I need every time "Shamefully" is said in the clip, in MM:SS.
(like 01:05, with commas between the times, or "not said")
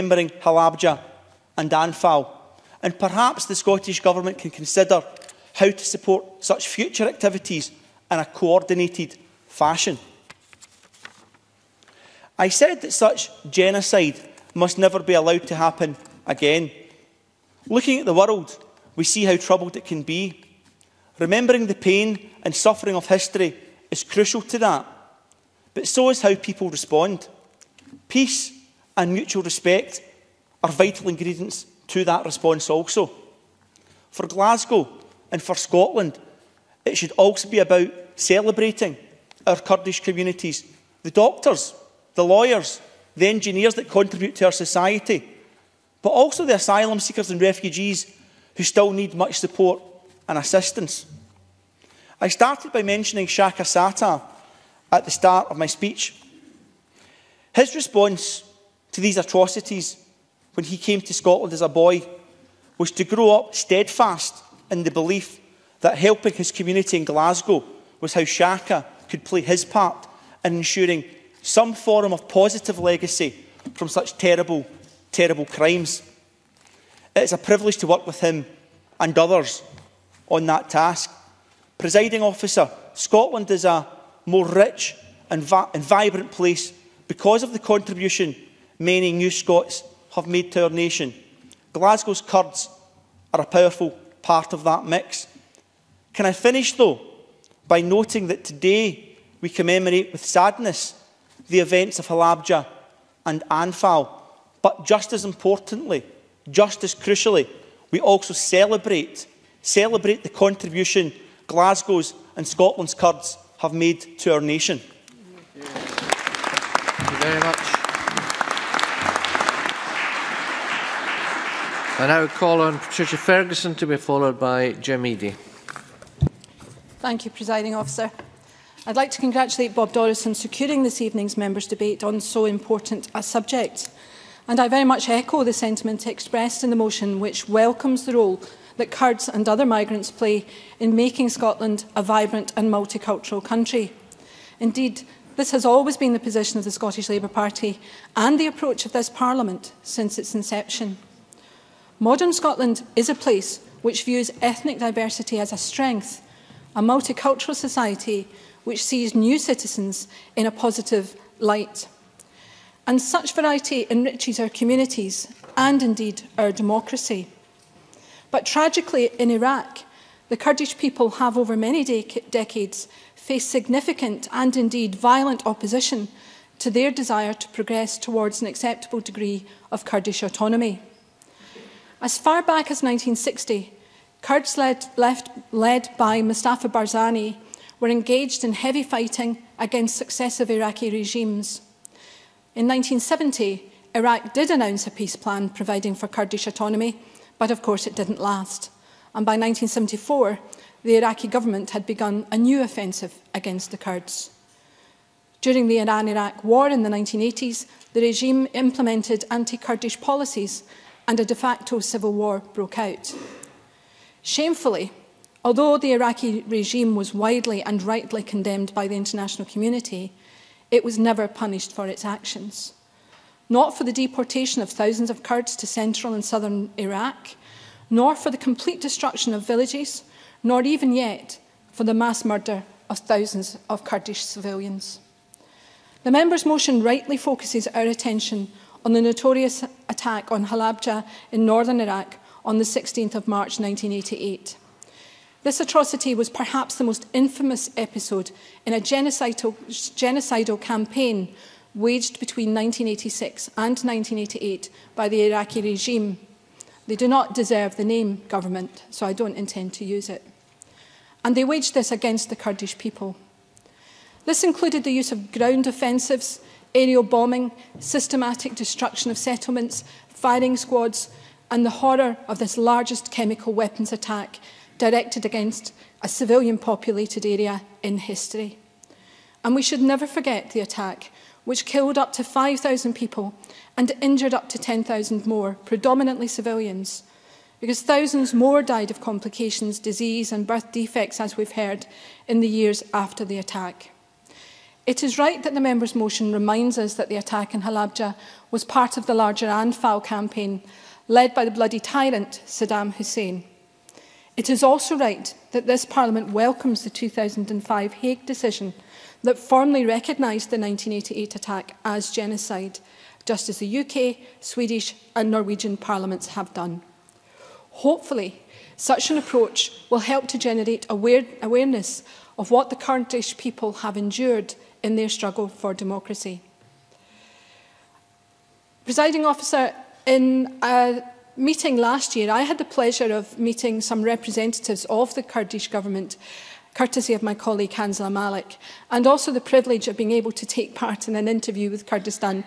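03:34.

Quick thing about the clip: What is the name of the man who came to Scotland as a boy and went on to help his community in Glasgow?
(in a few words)
Shaka Sata.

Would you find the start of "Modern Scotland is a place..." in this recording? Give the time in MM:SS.
02:31.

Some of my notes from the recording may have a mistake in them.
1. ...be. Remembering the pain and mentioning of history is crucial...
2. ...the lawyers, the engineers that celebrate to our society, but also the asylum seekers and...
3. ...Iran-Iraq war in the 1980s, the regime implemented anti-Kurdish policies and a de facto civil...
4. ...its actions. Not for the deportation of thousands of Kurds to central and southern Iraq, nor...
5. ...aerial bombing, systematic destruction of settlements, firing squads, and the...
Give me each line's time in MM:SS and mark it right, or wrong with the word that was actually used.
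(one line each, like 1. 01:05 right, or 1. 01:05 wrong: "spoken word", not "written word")
1. 00:20 wrong: "suffering", not "mentioning"
2. 00:42 wrong: "contribute", not "celebrate"
3. 03:25 right
4. 03:41 right
5. 04:26 right.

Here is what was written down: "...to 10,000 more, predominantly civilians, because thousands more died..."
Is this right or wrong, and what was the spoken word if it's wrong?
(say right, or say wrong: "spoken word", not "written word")
right.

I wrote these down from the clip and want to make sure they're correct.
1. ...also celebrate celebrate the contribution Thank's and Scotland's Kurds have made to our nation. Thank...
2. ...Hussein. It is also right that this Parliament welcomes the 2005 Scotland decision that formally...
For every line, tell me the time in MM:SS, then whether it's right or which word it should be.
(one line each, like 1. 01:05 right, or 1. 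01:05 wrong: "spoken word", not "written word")
1. 01:48 wrong: "Glasgow", not "Thank"
2. 05:02 wrong: "Hague", not "Scotland".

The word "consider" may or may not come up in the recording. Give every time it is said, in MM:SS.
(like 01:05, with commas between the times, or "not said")
00:04.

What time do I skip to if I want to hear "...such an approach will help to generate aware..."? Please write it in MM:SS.
05:18.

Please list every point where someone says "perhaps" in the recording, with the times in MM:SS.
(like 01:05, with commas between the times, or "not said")
00:02, 04:06.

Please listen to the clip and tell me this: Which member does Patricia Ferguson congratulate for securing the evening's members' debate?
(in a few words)
Bob Doris.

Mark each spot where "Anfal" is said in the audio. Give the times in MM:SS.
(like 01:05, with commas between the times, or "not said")
00:01, 01:43, 04:59.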